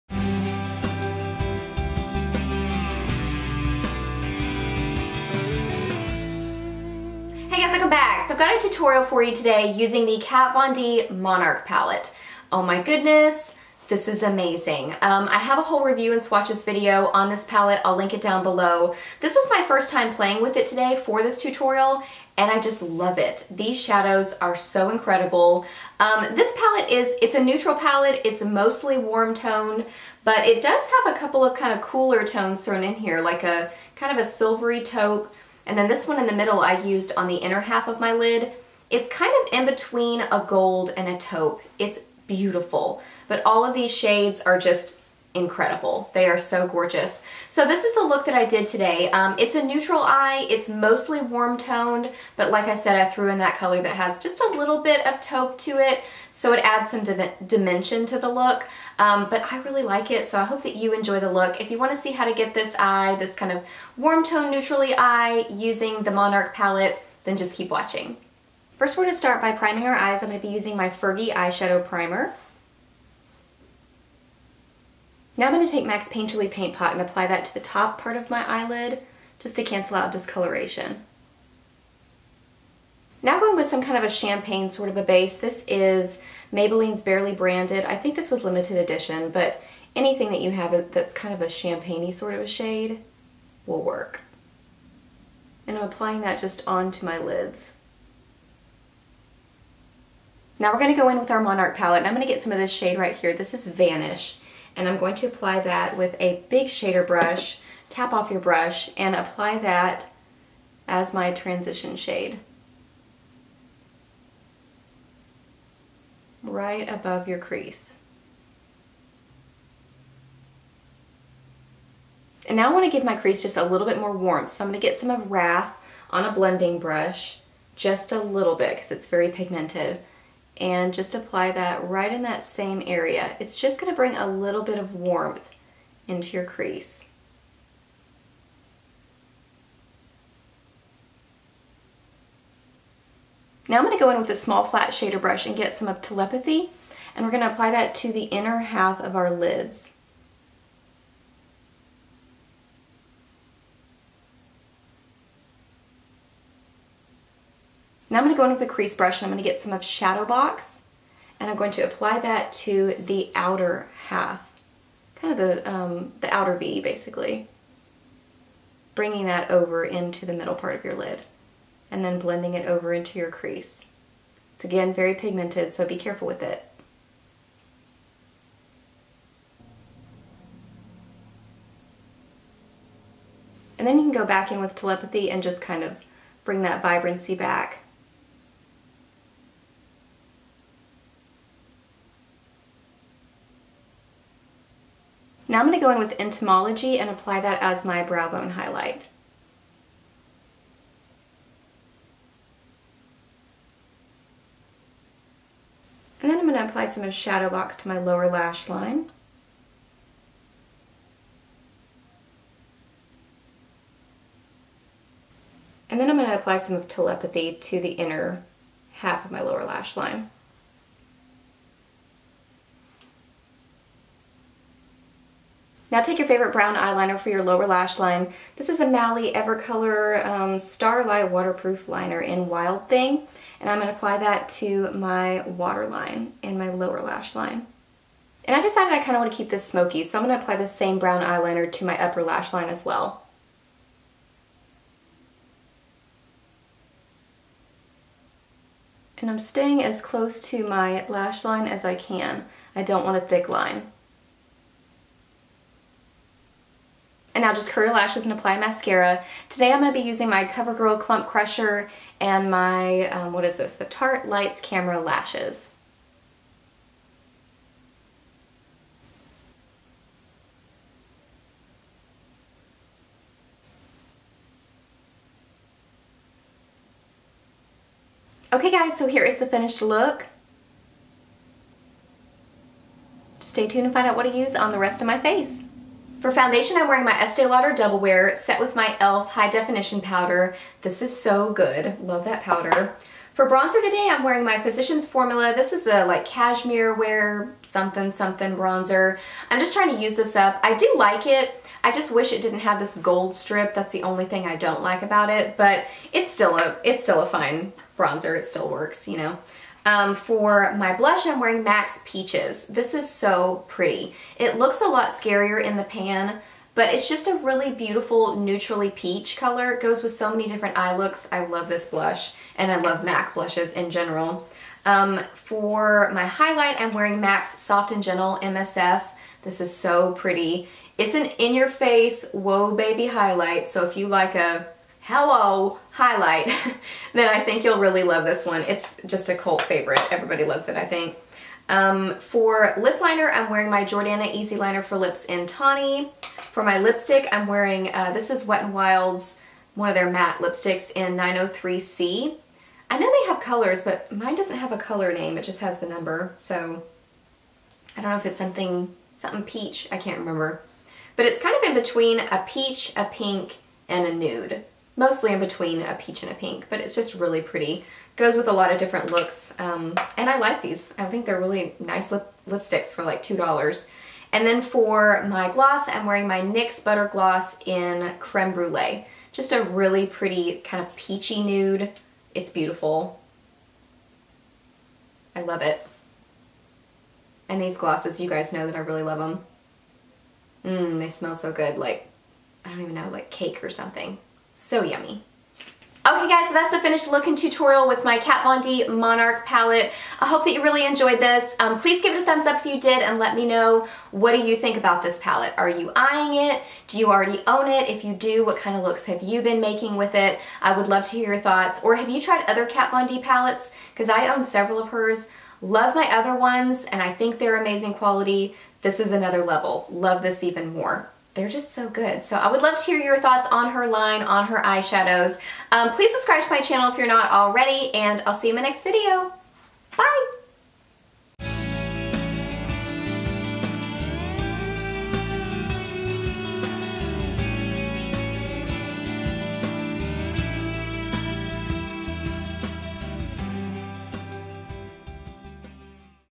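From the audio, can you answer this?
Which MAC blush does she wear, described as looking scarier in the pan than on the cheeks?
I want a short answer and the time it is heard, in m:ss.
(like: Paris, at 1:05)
Peaches, at 5:12.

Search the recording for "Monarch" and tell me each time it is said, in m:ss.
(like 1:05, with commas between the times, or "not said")
0:11, 1:06, 1:41, 6:38.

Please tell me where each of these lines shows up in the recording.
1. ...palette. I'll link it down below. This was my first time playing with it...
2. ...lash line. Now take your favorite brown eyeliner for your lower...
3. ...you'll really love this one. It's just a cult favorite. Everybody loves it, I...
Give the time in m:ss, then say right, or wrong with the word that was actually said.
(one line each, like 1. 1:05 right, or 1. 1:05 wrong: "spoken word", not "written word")
1. 0:17 right
2. 3:39 right
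3. 5:37 right.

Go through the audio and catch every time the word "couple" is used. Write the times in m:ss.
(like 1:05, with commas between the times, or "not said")
0:31.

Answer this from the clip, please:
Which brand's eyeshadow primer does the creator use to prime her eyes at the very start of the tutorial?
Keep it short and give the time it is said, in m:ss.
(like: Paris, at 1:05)
Fergie, at 1:10.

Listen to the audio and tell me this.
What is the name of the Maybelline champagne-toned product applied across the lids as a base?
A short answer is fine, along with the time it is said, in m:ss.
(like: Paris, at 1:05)
Barely Branded, at 1:27.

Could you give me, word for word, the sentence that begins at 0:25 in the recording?
Um, this palette is, it's a neutral palette.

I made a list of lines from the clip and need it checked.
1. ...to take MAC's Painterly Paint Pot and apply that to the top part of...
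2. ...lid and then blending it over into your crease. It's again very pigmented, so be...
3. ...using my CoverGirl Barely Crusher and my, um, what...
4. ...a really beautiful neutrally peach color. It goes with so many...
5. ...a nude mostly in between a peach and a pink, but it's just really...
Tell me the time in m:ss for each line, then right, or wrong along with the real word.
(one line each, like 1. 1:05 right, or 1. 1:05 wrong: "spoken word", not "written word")
1. 1:15 right
2. 2:50 right
3. 4:20 wrong: "Clump", not "Barely"
4. 5:17 right
5. 6:04 right.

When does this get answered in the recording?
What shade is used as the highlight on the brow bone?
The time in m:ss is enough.
3:16.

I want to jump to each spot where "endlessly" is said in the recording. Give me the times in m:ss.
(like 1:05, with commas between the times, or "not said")
not said.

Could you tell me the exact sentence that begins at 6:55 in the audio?
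Love my other ones and I think they're amazing quality.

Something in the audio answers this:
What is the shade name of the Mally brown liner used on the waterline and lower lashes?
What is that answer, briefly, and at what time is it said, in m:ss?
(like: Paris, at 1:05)
Wild Thing, at 3:52.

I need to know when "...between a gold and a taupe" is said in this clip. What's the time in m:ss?
0:39.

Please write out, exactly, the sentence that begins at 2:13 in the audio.
It's just going to bring a little bit of warmth into your crease.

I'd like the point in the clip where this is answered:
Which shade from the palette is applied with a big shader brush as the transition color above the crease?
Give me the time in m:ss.
1:43.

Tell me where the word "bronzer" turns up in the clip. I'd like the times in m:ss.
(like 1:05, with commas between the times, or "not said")
4:53, 4:58, 5:07.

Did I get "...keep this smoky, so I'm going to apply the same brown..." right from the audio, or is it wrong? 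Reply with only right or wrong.
right.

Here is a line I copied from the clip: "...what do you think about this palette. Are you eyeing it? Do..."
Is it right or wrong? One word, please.
right.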